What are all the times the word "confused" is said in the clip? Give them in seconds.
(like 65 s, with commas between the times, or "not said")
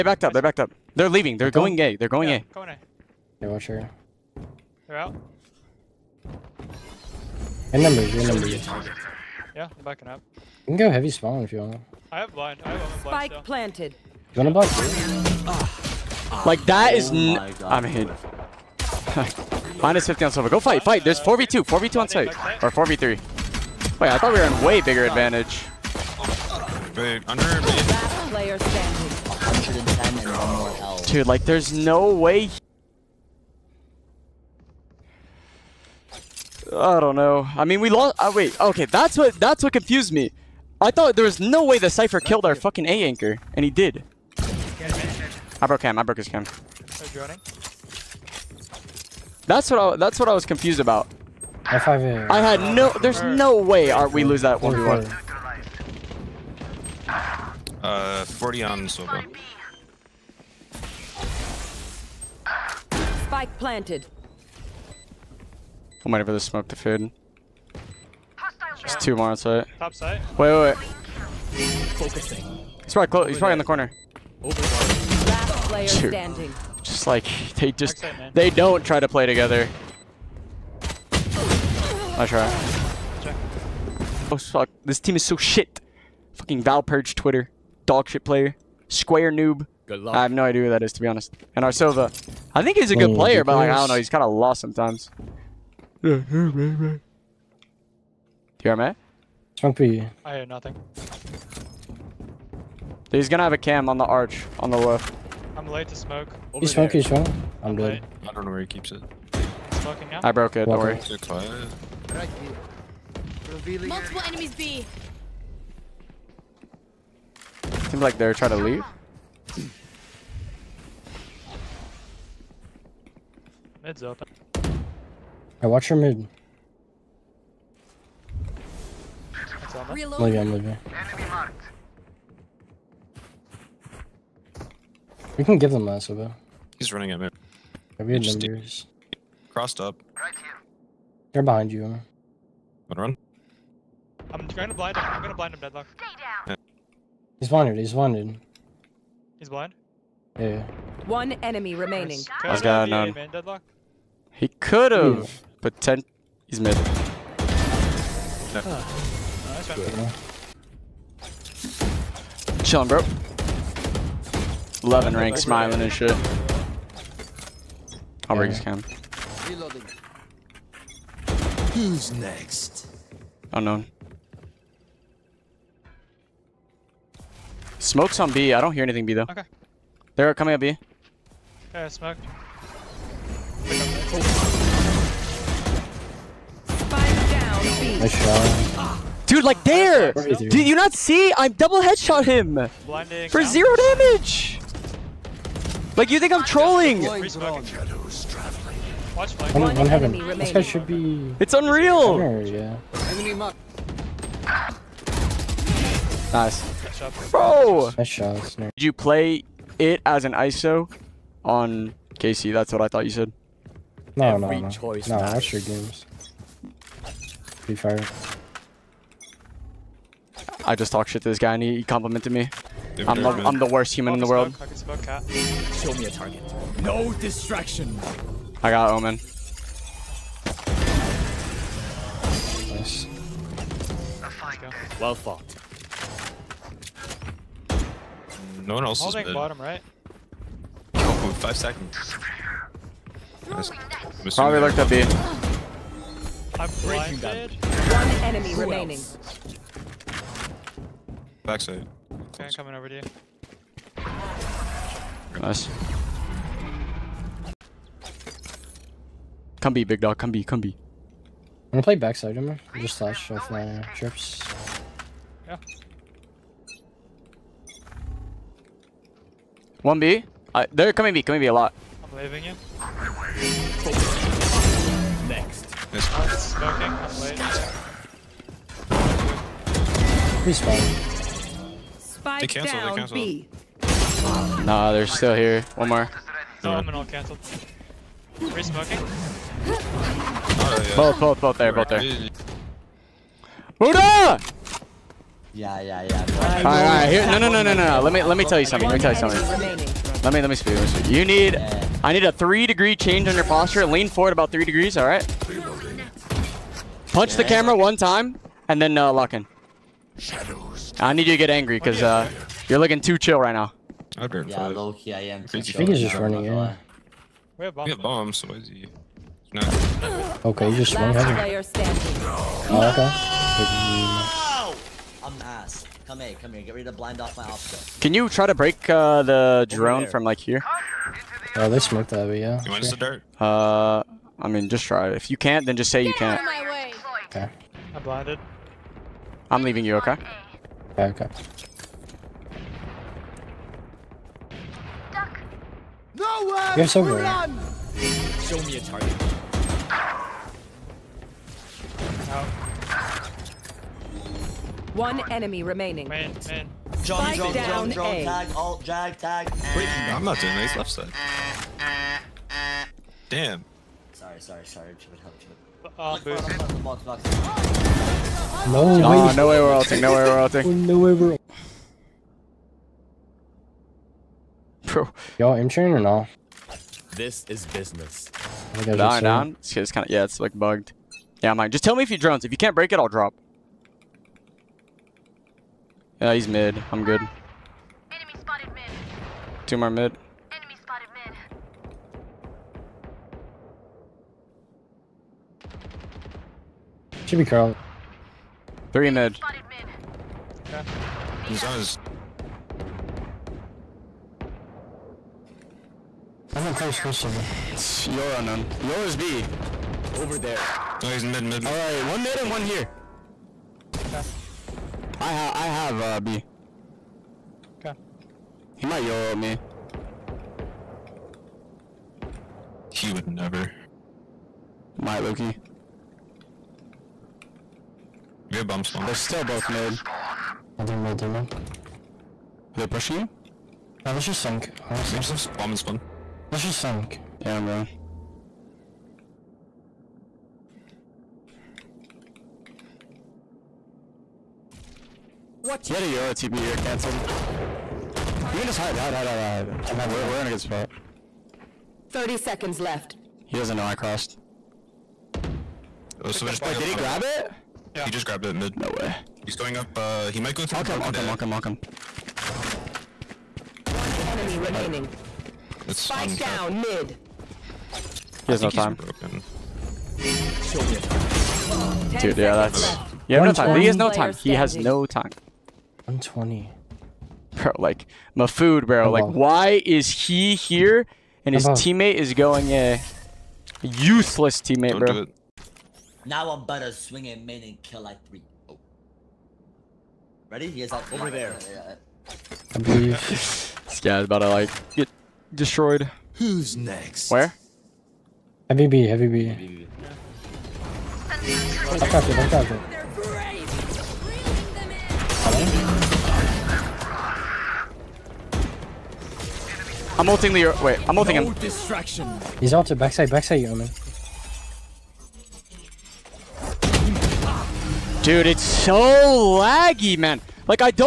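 39 s, 50 s.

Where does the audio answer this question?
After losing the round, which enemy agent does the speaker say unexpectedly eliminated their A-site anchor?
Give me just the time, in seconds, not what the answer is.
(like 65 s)
41 s.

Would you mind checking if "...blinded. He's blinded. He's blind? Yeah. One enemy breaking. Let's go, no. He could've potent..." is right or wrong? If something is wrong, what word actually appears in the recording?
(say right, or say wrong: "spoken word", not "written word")
wrong: "remaining", not "breaking".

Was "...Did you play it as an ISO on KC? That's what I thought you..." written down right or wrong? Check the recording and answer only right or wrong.
right.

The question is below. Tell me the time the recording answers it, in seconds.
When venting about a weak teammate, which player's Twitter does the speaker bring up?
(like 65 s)
86 s.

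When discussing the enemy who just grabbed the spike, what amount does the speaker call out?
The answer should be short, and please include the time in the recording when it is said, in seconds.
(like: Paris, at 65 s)
120, at 476 s.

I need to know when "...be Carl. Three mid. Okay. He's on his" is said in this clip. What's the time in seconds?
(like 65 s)
397 s.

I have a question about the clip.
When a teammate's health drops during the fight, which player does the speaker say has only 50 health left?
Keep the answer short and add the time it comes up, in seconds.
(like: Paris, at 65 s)
Silva, at 19 s.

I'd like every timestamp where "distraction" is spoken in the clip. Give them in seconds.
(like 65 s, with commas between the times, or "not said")
227 s, 511 s.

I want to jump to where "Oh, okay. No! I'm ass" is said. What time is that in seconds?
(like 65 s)
322 s.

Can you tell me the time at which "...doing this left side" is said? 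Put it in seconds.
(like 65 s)
360 s.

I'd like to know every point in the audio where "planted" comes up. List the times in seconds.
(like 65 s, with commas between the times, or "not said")
13 s, 63 s.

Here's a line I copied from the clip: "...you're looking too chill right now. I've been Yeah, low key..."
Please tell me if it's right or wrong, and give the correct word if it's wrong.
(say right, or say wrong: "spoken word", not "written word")
right.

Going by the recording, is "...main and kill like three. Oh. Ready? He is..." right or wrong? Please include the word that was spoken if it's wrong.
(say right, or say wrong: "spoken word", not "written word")
right.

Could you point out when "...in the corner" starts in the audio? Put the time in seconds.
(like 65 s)
73 s.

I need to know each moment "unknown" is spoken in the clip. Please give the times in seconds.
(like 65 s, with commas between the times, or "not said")
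173 s, 408 s.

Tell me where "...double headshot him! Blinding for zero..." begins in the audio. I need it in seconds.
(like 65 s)
191 s.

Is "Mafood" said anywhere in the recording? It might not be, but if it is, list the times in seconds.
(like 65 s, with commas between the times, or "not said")
478 s.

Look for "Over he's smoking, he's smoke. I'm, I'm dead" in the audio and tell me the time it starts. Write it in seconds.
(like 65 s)
106 s.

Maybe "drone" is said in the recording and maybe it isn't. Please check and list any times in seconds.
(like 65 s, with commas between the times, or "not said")
329 s, 382 s.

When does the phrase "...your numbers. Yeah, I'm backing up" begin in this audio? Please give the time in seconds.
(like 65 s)
8 s.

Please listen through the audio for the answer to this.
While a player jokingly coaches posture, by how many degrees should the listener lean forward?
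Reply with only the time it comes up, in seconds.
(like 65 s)
304 s.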